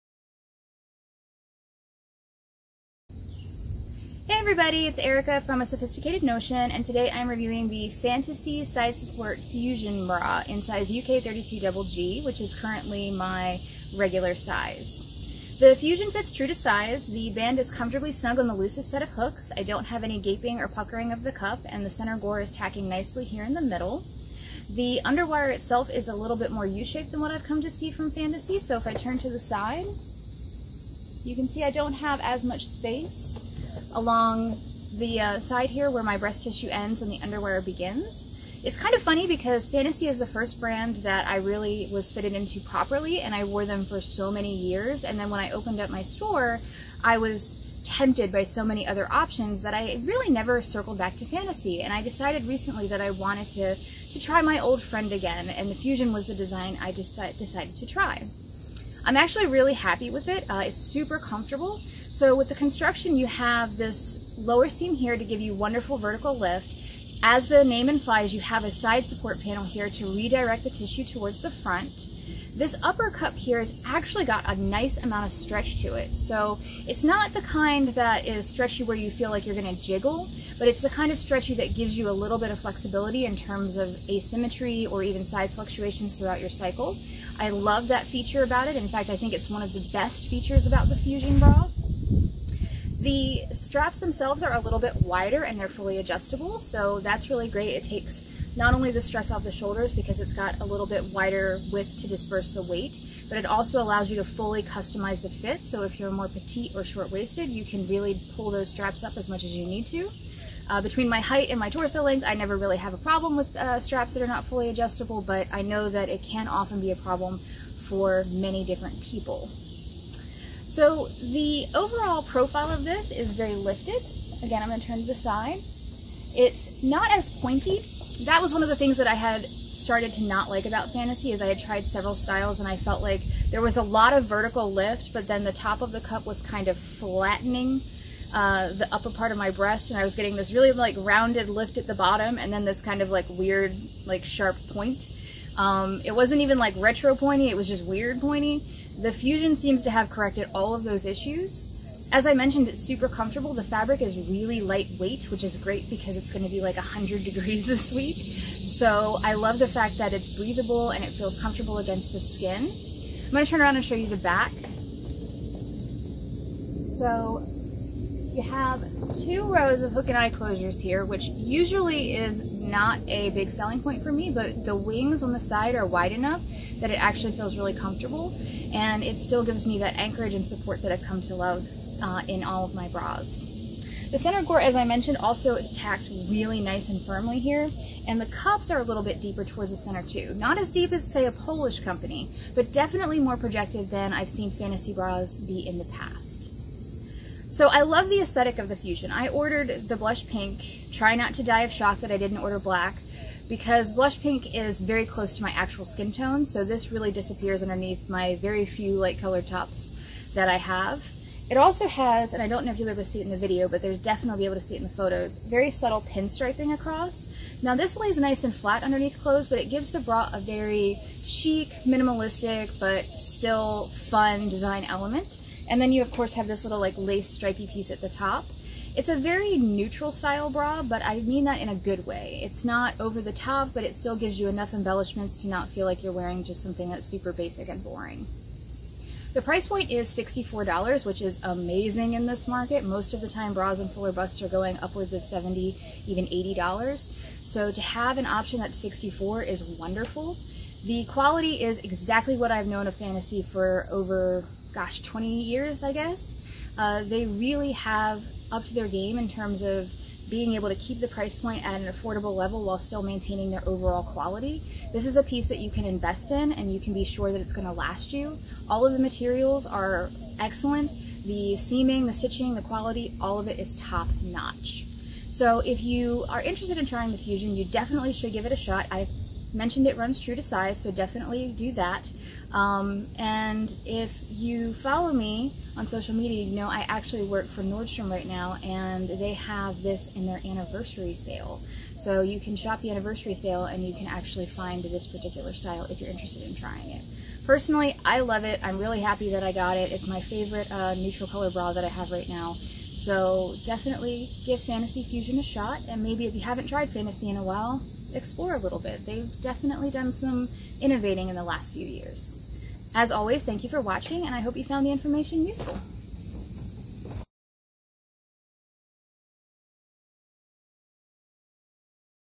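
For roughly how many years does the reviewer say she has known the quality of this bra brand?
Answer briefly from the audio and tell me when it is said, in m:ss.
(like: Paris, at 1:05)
20 years, at 4:15.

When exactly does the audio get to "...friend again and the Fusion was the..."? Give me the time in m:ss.
0:54.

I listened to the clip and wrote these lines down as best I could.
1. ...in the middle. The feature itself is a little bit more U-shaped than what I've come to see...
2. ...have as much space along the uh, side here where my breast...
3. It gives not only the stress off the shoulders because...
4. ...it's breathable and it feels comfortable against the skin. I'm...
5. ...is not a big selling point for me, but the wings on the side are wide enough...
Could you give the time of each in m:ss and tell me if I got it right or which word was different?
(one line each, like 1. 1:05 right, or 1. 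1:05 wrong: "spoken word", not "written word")
1. 0:23 wrong: "underwire", not "feature"
2. 0:31 right
3. 1:37 wrong: "takes", not "gives"
4. 2:40 right
5. 2:52 right.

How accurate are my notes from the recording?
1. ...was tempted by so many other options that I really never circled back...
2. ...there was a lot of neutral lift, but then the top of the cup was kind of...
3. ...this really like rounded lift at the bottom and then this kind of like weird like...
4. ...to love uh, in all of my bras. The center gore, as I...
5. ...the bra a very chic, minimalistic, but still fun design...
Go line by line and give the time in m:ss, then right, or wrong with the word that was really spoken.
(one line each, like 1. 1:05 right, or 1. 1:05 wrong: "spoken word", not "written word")
1. 0:47 right
2. 2:13 wrong: "vertical", not "neutral"
3. 2:20 right
4. 3:01 right
5. 3:39 right.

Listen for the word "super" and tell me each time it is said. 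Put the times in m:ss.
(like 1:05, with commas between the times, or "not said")
1:00, 2:32, 3:57.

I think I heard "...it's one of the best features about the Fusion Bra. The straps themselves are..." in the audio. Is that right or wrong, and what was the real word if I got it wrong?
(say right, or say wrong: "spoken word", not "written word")
right.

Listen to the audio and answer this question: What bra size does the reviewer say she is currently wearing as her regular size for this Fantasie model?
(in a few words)
UK 32 Double G.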